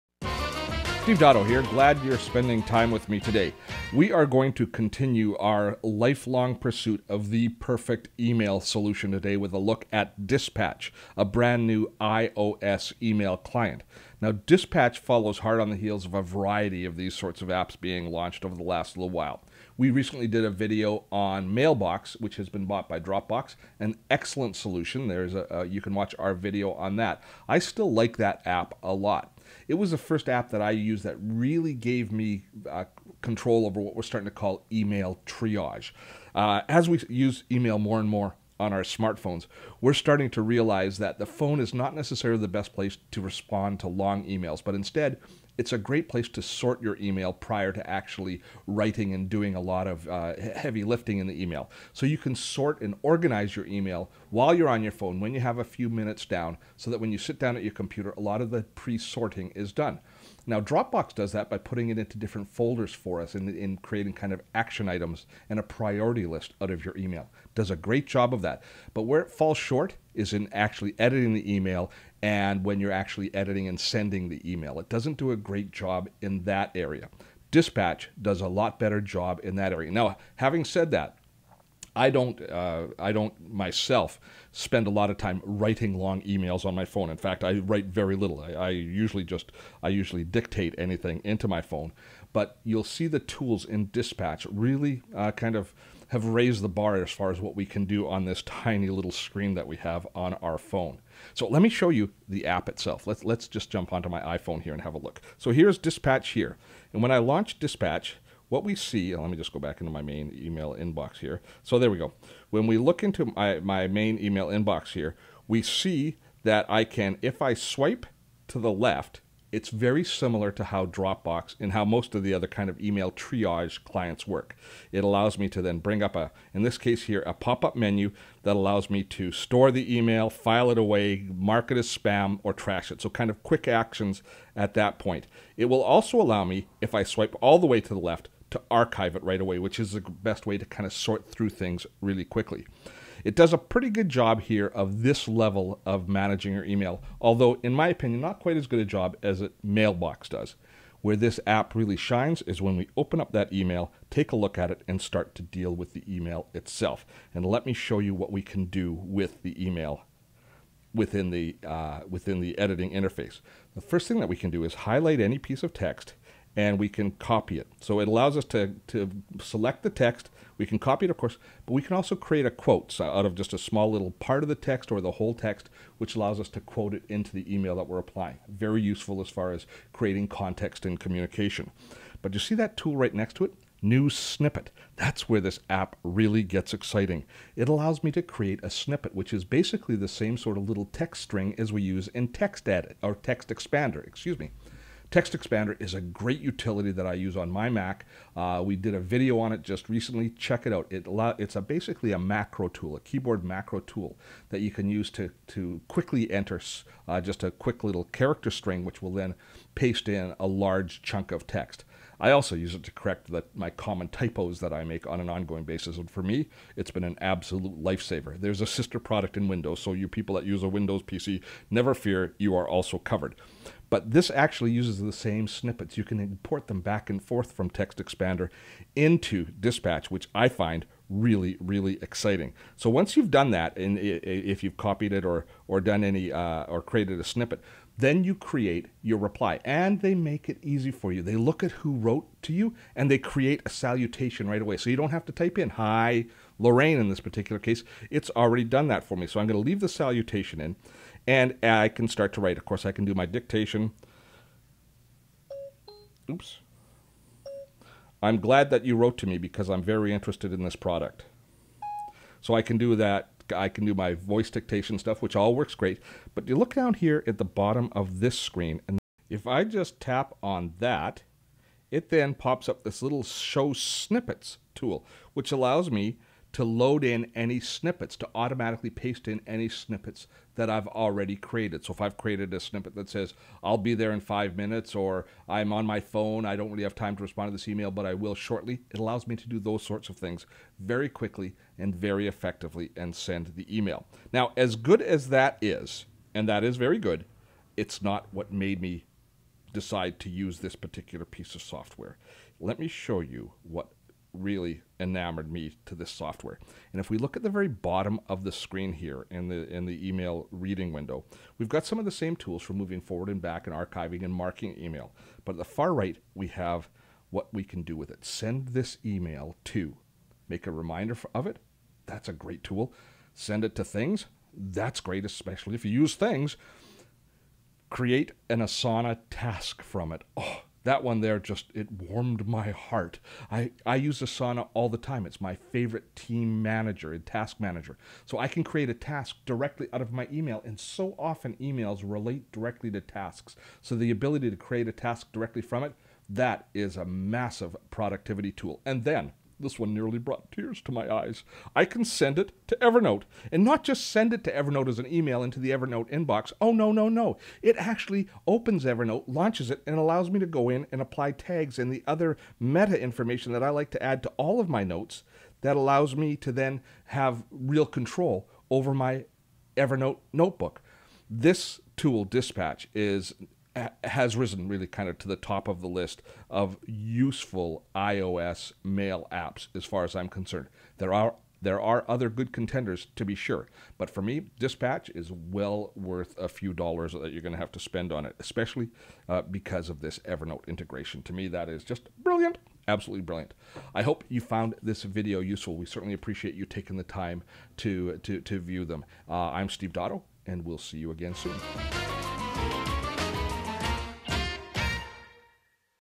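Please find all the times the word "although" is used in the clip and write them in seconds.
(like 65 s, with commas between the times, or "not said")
147 s.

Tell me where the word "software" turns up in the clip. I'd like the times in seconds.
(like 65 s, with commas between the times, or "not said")
301 s, 306 s.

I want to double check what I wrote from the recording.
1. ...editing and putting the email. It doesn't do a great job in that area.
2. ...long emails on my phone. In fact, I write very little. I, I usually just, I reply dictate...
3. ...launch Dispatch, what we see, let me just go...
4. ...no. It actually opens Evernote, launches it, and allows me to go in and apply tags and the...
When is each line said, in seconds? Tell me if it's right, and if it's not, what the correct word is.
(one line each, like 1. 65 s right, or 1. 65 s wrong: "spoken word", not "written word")
1. 73 s wrong: "sending", not "putting"
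2. 85 s wrong: "usually", not "reply"
3. 107 s right
4. 357 s right.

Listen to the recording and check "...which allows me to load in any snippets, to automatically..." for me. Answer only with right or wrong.
right.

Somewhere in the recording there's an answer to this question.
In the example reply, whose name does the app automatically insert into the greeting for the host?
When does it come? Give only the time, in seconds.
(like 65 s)
246 s.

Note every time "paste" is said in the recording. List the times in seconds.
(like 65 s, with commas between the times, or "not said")
209 s, 278 s.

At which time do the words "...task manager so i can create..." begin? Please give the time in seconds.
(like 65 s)
337 s.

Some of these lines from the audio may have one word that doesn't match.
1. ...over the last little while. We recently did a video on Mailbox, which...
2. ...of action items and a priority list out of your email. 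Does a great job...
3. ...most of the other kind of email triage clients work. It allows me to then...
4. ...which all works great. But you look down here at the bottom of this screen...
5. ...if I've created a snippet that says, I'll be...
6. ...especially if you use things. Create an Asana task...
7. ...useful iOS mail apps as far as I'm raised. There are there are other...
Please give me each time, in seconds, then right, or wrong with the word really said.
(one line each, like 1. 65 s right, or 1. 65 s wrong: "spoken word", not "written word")
1. 18 s right
2. 64 s right
3. 121 s right
4. 265 s right
5. 281 s right
6. 325 s right
7. 376 s wrong: "concerned", not "raised".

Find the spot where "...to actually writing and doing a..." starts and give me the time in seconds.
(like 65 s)
47 s.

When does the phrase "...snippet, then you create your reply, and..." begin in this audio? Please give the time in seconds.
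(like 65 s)
237 s.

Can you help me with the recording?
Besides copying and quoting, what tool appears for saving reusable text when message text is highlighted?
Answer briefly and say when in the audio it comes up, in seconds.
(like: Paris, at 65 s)
New snippet, at 183 s.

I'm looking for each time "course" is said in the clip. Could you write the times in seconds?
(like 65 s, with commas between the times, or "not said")
171 s, 252 s.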